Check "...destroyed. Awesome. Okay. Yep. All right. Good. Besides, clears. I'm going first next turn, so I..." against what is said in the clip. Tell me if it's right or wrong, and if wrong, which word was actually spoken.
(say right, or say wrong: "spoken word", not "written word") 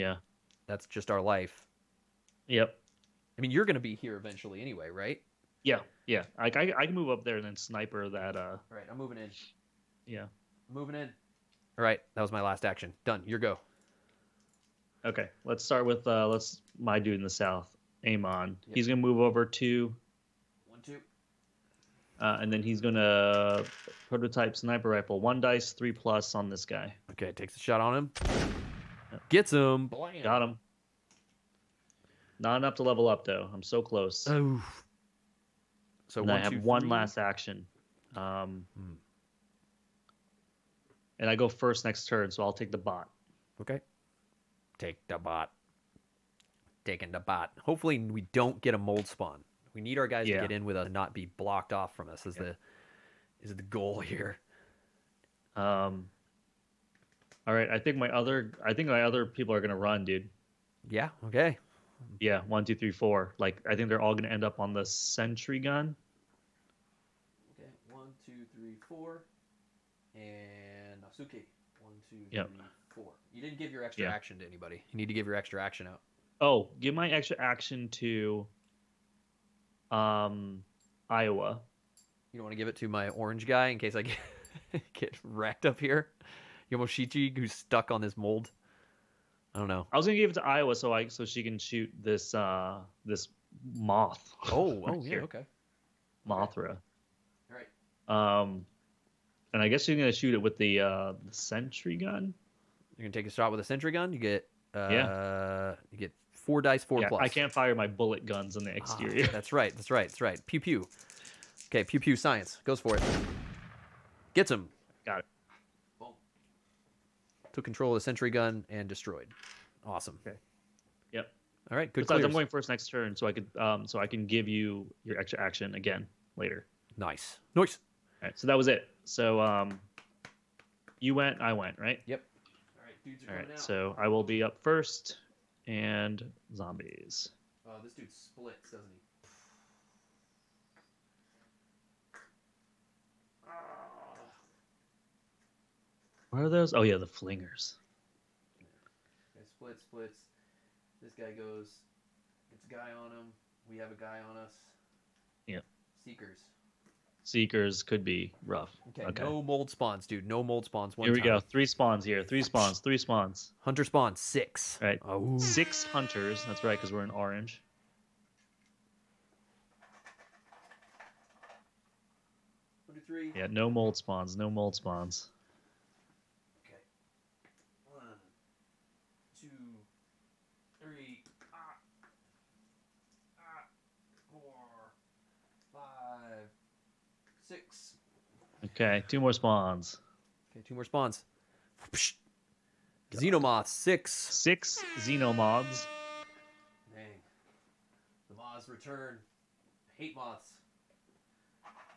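right.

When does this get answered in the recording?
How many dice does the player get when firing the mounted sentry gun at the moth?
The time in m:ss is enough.
1:46.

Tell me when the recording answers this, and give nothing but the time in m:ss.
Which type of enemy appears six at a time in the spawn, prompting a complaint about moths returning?
3:13.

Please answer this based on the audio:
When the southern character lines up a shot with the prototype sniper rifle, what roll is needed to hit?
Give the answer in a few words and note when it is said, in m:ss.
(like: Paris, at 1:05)
3+, at 0:25.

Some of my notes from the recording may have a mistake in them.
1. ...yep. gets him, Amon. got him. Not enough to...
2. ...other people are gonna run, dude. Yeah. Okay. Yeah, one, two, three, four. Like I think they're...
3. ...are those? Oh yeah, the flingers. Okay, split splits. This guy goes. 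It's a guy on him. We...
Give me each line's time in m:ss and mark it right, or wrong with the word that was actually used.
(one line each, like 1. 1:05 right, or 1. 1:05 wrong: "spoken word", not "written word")
1. 0:29 wrong: "Blam", not "Amon"
2. 0:59 right
3. 2:26 right.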